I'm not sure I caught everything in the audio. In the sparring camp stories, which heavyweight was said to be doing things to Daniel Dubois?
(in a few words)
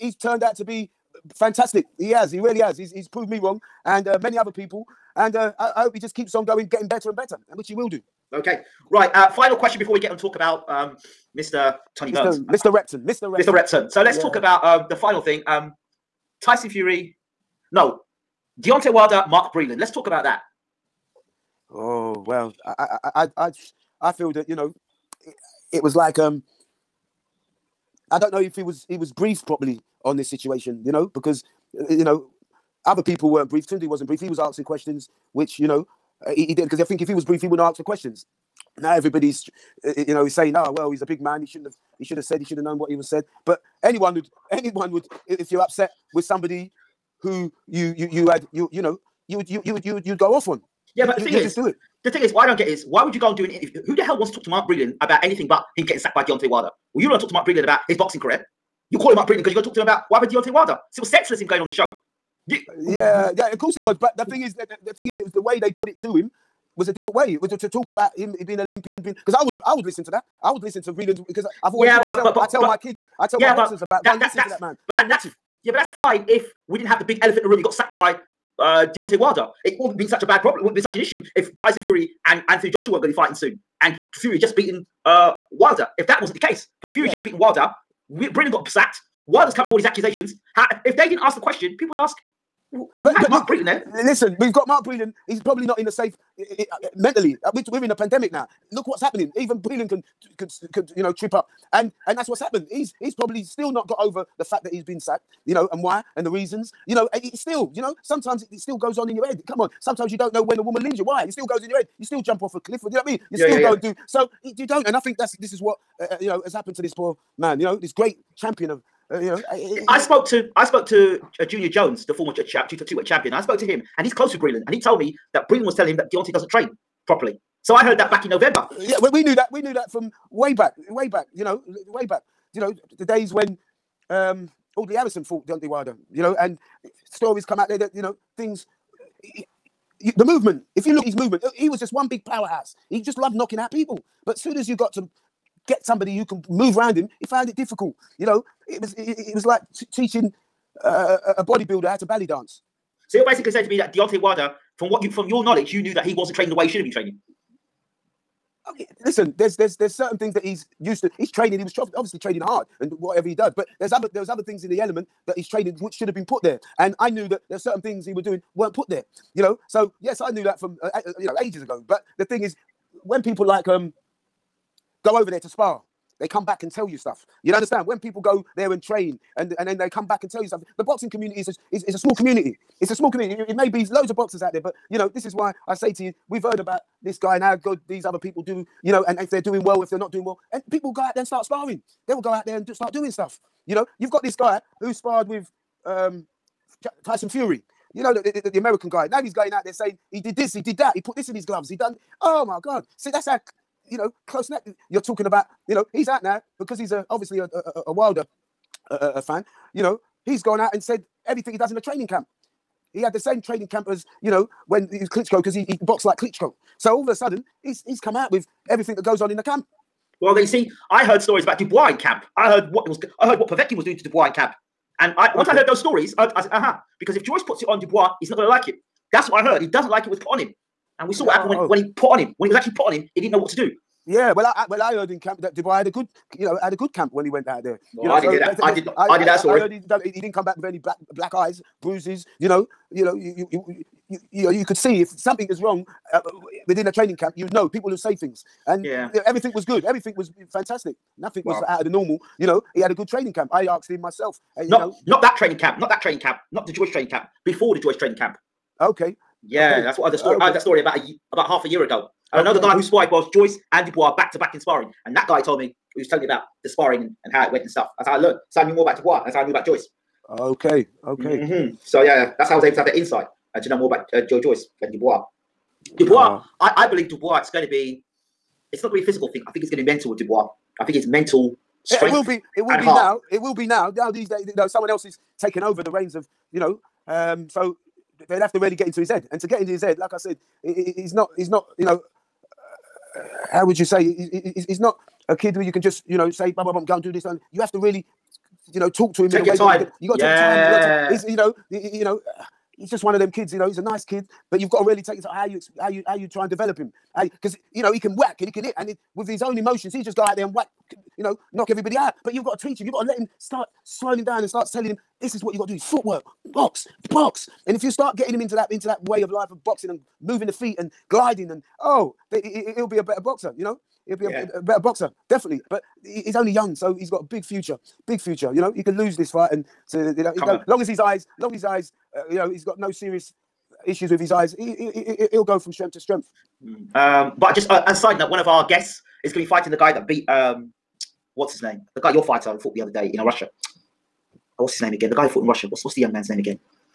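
Povetkin.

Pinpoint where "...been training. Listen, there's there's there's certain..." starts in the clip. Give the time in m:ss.
2:36.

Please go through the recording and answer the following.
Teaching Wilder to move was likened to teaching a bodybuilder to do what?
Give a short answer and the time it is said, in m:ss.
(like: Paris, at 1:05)
belly dance, at 2:32.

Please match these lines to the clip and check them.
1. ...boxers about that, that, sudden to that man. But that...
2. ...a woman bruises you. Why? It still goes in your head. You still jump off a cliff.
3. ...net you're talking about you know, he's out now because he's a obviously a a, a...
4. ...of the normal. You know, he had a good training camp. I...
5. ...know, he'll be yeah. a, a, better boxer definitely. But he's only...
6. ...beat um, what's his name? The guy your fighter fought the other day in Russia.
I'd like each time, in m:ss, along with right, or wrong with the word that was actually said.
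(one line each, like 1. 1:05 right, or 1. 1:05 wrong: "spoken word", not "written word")
1. 1:13 wrong: "listen", not "sudden"
2. 1:50 wrong: "leaves", not "bruises"
3. 3:24 right
4. 4:11 right
5. 5:23 right
6. 5:40 right.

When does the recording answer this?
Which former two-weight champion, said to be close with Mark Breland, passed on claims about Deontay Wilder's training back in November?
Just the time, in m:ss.
2:01.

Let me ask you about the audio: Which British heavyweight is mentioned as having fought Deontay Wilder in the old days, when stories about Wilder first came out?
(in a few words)
Audley Harrison.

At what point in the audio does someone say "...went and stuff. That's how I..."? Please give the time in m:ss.
4:27.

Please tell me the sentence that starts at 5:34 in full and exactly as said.
He, he, he, he'll go from strength to strength.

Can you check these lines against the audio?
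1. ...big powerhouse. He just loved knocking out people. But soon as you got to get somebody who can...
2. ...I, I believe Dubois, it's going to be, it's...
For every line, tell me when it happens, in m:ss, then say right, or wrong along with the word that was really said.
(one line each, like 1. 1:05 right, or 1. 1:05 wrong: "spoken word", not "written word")
1. 2:22 right
2. 4:36 right.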